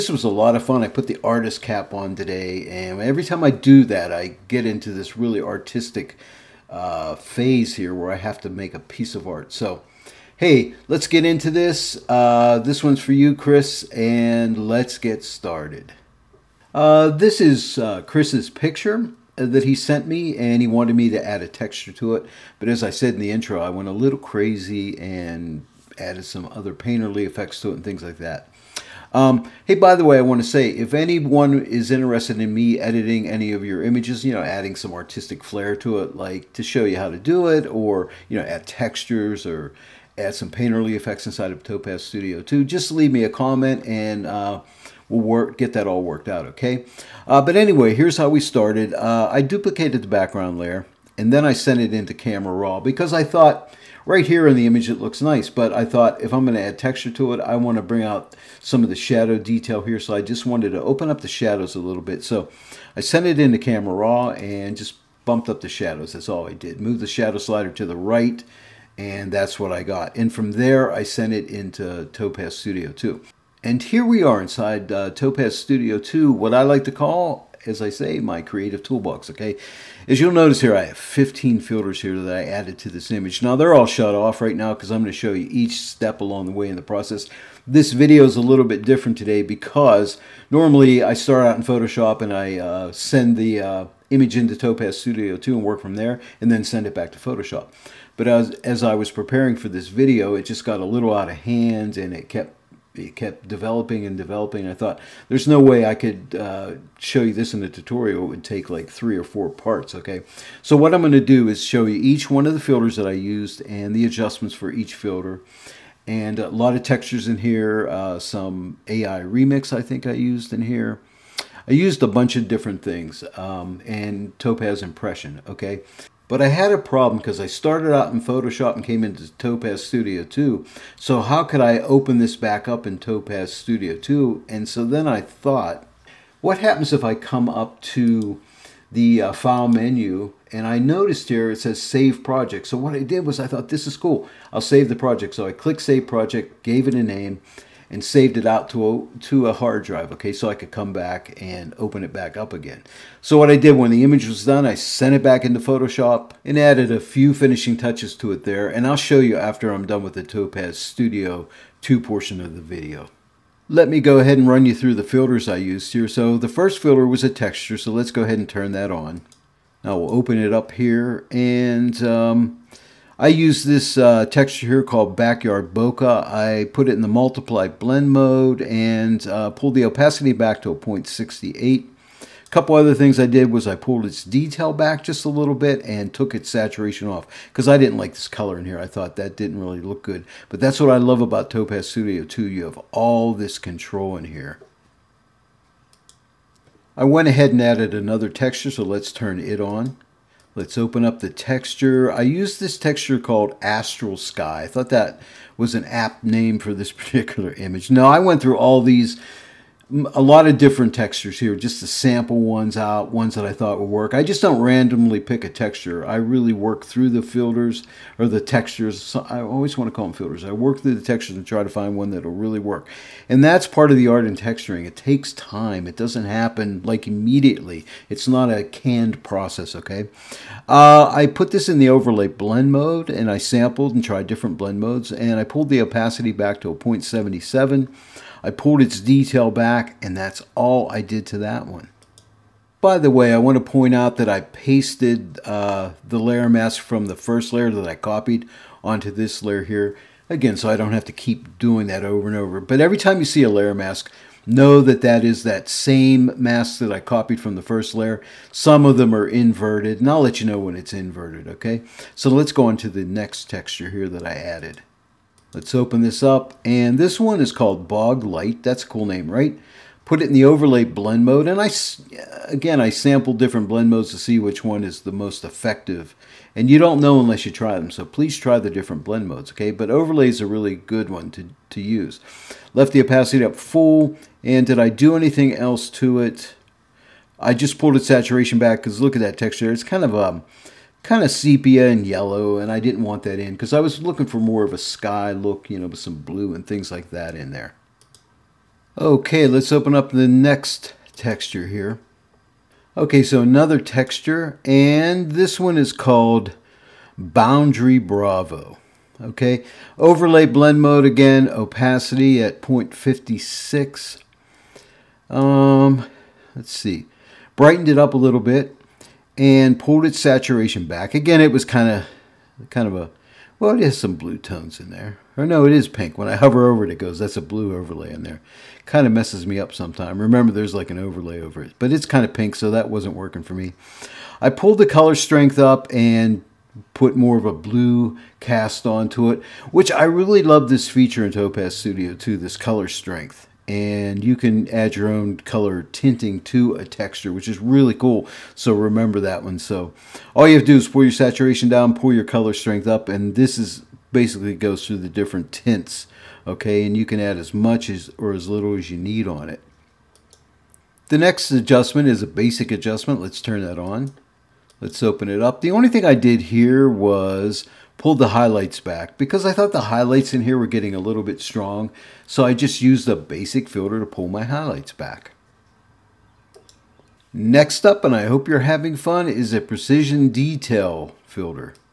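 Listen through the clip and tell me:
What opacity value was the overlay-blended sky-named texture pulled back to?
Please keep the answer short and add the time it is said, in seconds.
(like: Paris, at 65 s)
0.77, at 236 s.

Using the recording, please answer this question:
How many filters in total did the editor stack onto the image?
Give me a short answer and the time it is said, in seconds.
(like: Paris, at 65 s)
15, at 80 s.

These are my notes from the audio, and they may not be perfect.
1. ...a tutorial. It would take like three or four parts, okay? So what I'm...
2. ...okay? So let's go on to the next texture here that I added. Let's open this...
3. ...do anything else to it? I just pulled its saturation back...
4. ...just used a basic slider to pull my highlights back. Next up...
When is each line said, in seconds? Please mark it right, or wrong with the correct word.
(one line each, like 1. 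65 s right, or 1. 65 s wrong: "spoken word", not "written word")
1. 107 s right
2. 261 s right
3. 284 s right
4. 372 s wrong: "filter", not "slider".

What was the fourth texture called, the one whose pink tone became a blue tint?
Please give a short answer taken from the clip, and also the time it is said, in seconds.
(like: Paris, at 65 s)
Boundary Bravo, at 307 s.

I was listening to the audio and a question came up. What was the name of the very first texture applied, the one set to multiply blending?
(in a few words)
Backyard Bokeh.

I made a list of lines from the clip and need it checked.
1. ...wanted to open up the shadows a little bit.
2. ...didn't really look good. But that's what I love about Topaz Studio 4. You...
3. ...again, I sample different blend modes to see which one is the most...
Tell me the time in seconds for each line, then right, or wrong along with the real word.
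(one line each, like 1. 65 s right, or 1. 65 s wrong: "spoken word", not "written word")
1. 60 s right
2. 189 s wrong: "2", not "4"
3. 272 s right.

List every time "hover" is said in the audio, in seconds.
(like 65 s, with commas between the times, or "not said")
326 s.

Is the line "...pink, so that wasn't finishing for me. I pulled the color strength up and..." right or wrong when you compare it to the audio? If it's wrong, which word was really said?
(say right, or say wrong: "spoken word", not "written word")
wrong: "working", not "finishing".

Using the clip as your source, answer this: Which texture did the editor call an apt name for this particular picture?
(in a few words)
Astral Sky.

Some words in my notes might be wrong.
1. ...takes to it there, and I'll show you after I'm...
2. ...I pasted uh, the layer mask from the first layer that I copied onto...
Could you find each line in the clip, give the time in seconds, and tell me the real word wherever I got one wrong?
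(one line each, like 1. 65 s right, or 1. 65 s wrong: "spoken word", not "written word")
1. 157 s wrong: "touches", not "takes"
2. 244 s right.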